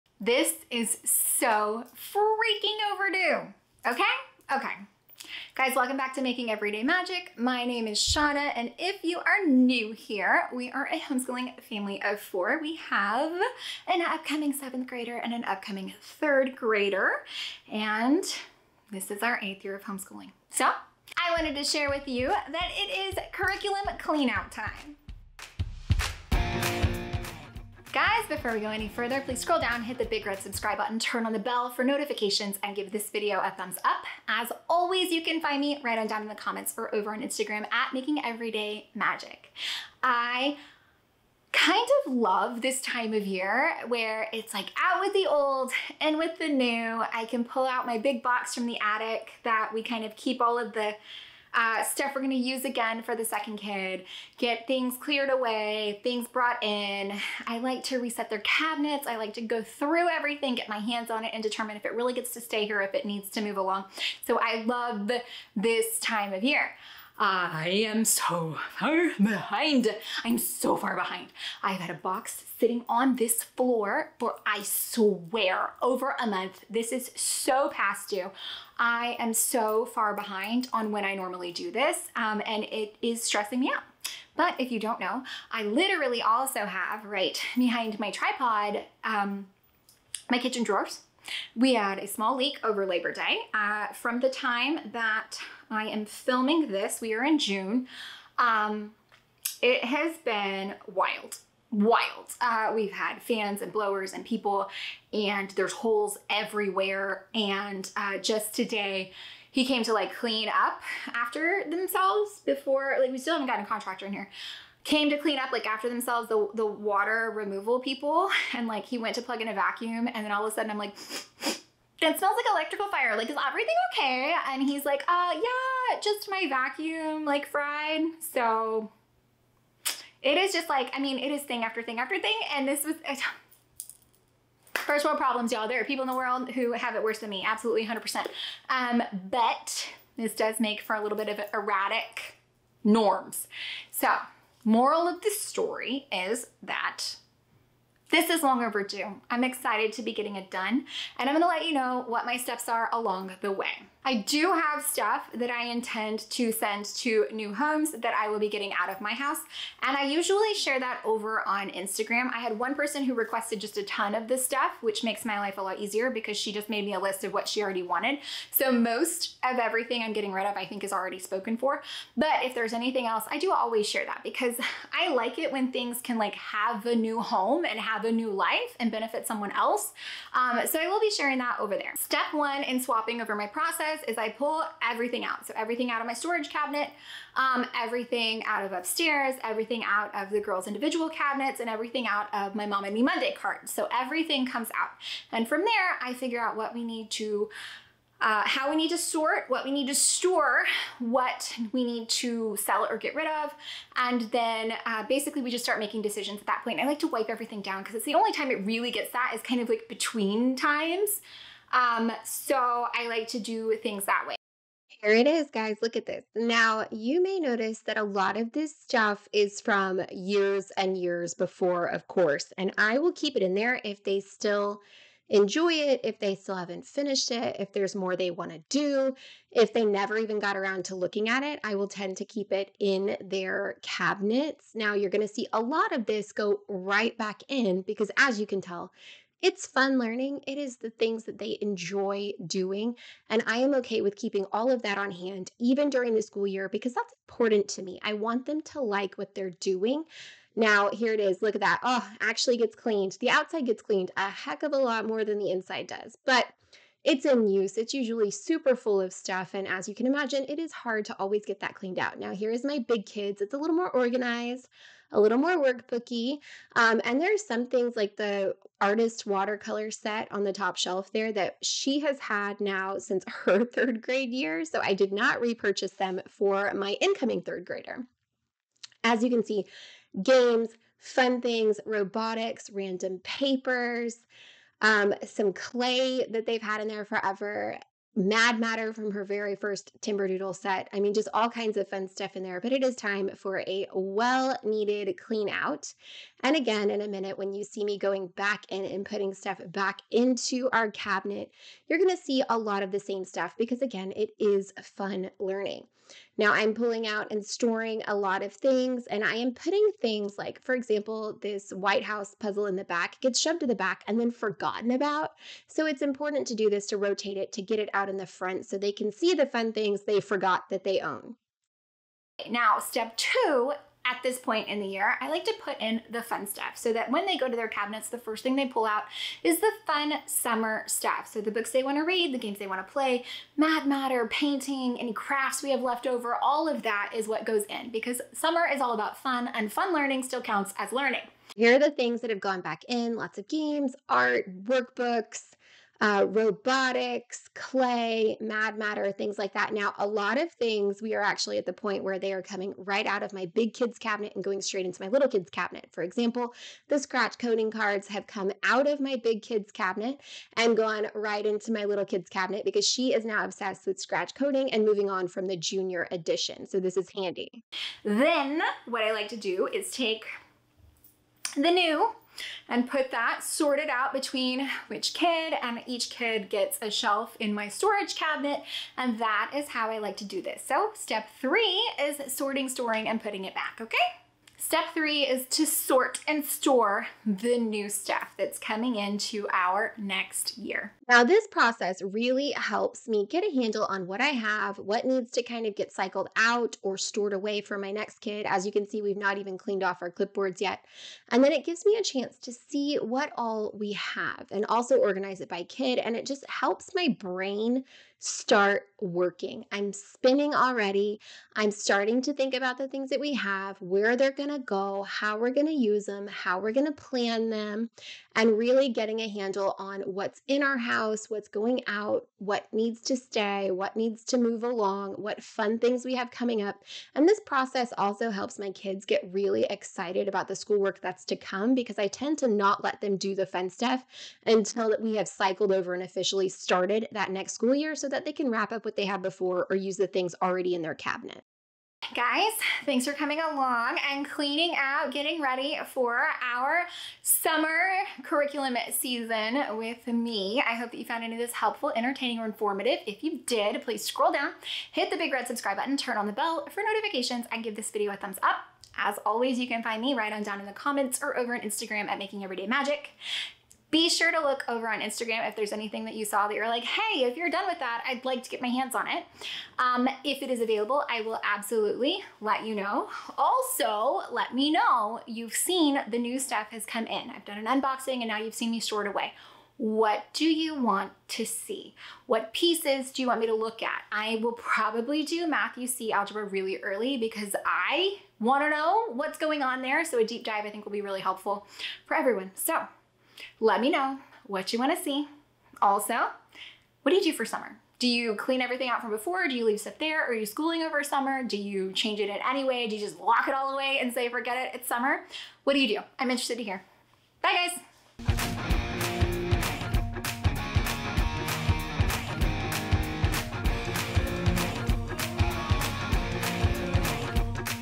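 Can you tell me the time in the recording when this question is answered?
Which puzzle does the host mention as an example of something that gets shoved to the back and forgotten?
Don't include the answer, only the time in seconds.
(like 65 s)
311 s.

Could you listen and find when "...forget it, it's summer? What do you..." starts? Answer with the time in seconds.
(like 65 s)
504 s.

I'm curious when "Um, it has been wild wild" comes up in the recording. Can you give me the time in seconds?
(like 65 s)
98 s.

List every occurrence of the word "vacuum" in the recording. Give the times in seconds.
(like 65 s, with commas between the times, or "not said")
119 s, 126 s.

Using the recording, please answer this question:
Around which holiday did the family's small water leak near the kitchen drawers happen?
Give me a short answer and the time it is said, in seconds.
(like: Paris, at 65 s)
Labor Day, at 92 s.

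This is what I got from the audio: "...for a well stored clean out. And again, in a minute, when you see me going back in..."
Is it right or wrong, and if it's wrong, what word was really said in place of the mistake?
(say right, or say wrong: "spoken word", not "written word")
wrong: "needed", not "stored".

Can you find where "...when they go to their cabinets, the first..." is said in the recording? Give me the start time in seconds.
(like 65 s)
327 s.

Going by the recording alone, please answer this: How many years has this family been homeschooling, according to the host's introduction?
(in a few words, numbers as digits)
8.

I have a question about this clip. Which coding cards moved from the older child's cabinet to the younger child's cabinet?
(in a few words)
Scratch coding cards.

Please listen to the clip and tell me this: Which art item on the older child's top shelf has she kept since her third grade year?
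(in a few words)
Artist watercolor set.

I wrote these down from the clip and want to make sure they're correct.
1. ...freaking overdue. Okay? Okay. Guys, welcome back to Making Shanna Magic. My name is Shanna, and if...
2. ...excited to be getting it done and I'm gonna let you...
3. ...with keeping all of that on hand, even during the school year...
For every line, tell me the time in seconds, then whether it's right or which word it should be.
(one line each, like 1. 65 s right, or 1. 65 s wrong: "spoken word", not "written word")
1. 1 s wrong: "Everyday", not "Shanna"
2. 149 s right
3. 244 s right.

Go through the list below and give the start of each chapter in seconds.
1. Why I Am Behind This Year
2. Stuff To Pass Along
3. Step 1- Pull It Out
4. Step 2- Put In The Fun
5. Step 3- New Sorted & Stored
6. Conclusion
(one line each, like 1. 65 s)
1. 45 s
2. 154 s
3. 182 s
4. 267 s
5. 298 s
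6. 441 s.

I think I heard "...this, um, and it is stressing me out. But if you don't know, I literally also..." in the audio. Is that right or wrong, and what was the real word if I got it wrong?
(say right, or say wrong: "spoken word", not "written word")
right.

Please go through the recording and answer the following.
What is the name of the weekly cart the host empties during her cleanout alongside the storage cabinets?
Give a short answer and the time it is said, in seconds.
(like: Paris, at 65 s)
Mom and Me Monday cart, at 192 s.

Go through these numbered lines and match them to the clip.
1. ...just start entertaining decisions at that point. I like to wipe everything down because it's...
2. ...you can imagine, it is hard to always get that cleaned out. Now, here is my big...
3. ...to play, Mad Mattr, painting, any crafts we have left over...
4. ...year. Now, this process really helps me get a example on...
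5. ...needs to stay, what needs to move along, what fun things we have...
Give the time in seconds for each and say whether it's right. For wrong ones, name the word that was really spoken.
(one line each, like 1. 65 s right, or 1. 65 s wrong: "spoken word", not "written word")
1. 205 s wrong: "making", not "entertaining"
2. 259 s right
3. 332 s right
4. 390 s wrong: "handle", not "example"
5. 422 s right.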